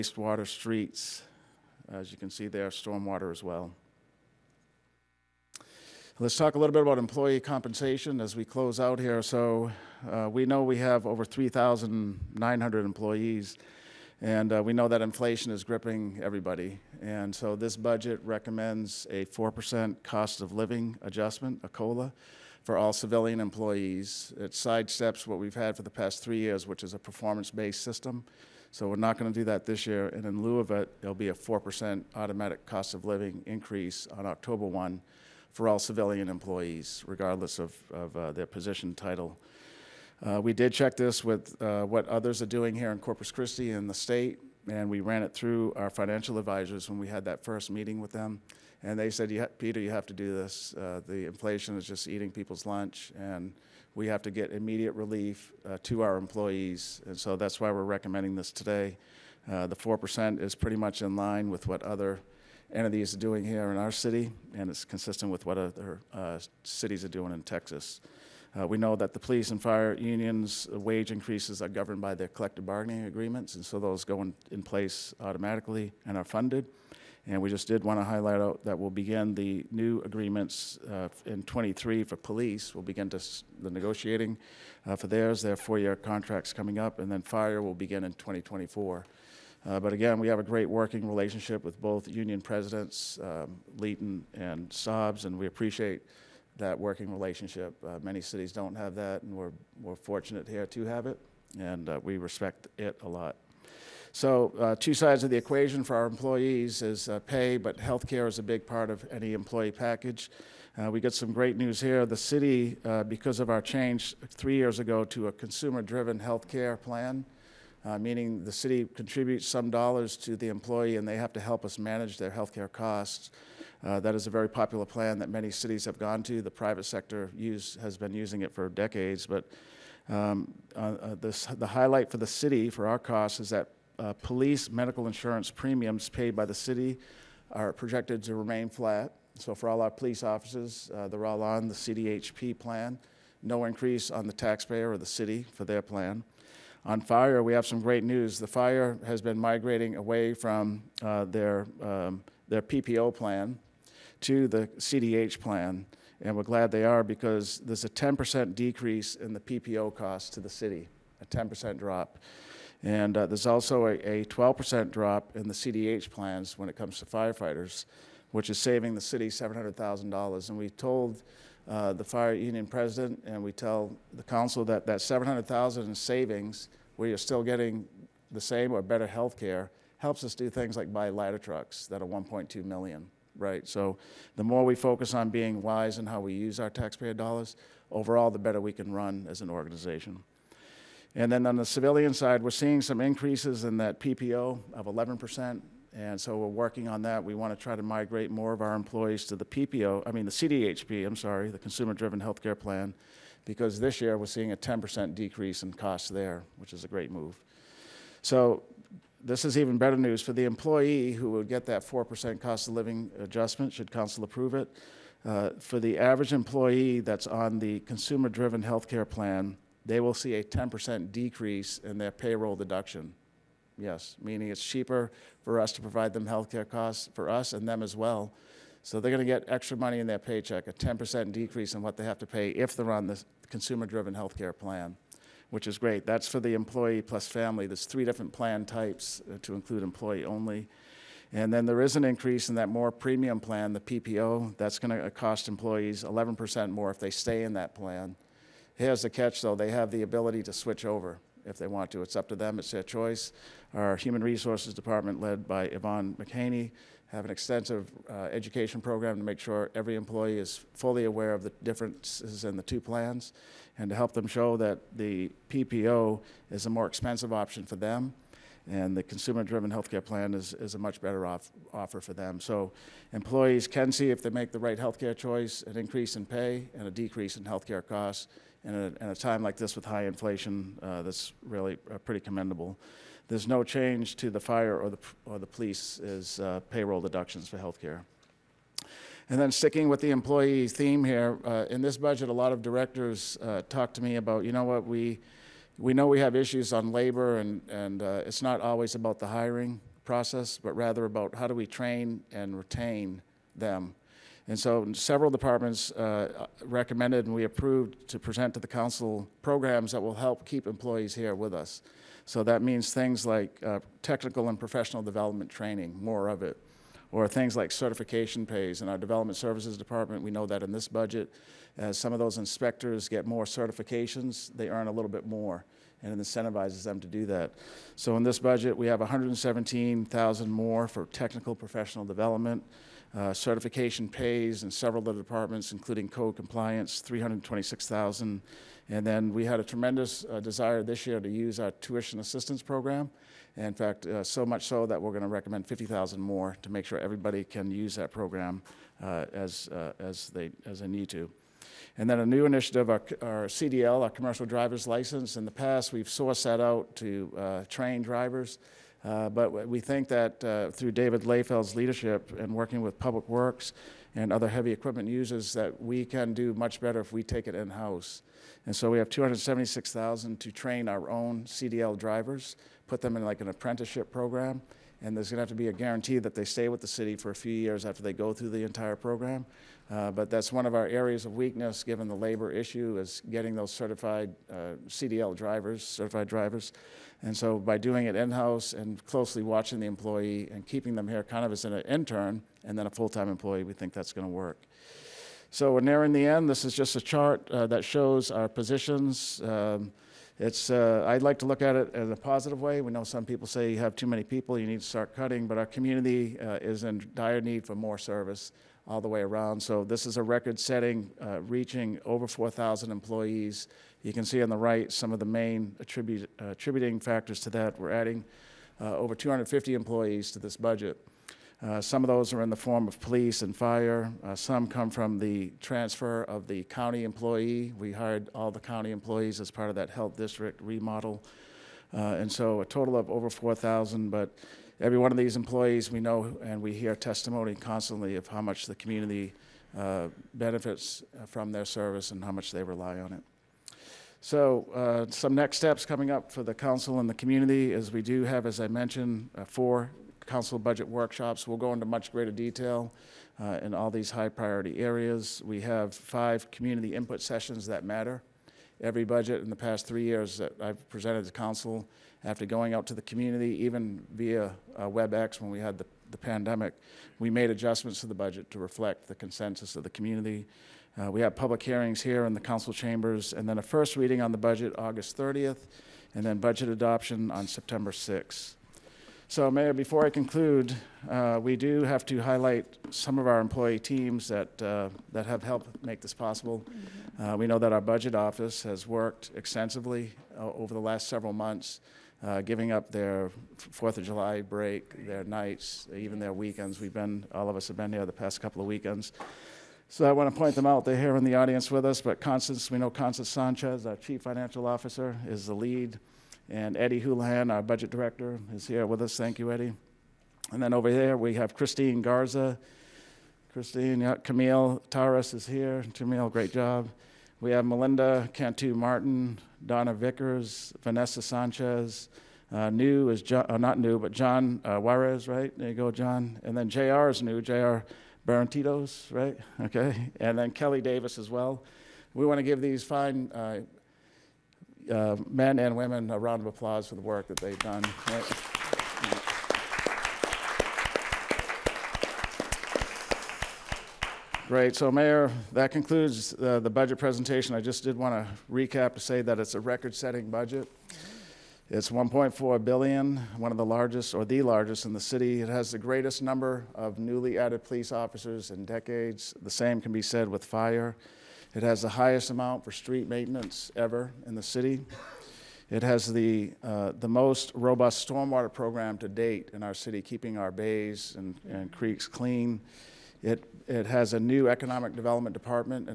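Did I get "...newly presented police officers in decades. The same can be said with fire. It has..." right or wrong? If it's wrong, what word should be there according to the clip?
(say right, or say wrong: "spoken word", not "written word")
wrong: "added", not "presented".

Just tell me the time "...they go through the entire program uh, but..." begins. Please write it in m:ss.
6:18.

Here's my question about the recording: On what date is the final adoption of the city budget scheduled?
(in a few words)
September 6th.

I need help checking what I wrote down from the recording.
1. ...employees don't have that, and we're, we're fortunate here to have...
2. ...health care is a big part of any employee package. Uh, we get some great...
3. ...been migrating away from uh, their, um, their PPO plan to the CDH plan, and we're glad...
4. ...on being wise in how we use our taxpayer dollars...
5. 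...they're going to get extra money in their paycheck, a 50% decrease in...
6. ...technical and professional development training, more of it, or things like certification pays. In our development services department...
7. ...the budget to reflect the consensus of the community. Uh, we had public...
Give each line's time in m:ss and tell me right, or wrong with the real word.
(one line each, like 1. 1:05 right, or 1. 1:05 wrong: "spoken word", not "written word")
1. 1:38 wrong: "cities", not "employees"
2. 1:47 right
3. 2:29 right
4. 3:05 right
5. 3:49 wrong: "10", not "50"
6. 5:14 right
7. 7:48 right.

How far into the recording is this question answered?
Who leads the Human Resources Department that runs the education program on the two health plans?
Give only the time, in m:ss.
4:15.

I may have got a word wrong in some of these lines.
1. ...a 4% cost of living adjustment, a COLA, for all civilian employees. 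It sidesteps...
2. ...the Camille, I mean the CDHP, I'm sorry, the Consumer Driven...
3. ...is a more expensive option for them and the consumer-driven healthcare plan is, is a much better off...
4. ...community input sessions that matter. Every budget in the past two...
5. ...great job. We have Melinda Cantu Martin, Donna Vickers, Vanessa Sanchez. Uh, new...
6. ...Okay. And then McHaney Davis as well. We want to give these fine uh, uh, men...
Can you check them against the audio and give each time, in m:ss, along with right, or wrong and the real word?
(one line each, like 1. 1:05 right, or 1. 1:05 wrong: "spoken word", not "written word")
1. 0:19 right
2. 3:19 wrong: "PPO", not "Camille"
3. 4:26 right
4. 7:36 wrong: "three", not "two"
5. 8:36 right
6. 8:49 wrong: "Kelly", not "McHaney".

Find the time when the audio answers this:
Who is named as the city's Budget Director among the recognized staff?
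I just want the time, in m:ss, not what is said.
8:26.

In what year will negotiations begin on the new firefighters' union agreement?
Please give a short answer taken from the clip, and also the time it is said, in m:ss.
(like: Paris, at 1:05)
2024, at 1:28.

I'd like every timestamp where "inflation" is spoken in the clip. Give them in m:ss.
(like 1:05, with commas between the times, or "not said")
0:15, 0:51, 4:40.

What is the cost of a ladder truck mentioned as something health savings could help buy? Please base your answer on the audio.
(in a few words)
1.2 million.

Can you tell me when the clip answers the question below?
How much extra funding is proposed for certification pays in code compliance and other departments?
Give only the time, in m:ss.
5:37.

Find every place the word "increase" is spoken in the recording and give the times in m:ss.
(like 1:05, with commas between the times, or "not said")
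0:33, 1:11, 2:23, 3:13, 4:02, 4:35.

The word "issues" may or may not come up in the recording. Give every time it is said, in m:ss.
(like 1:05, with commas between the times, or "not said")
4:56, 6:22.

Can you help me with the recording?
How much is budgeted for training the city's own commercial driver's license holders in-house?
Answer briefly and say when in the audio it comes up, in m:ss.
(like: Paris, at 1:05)
276,000, at 6:09.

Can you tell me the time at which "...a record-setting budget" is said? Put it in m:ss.
9:09.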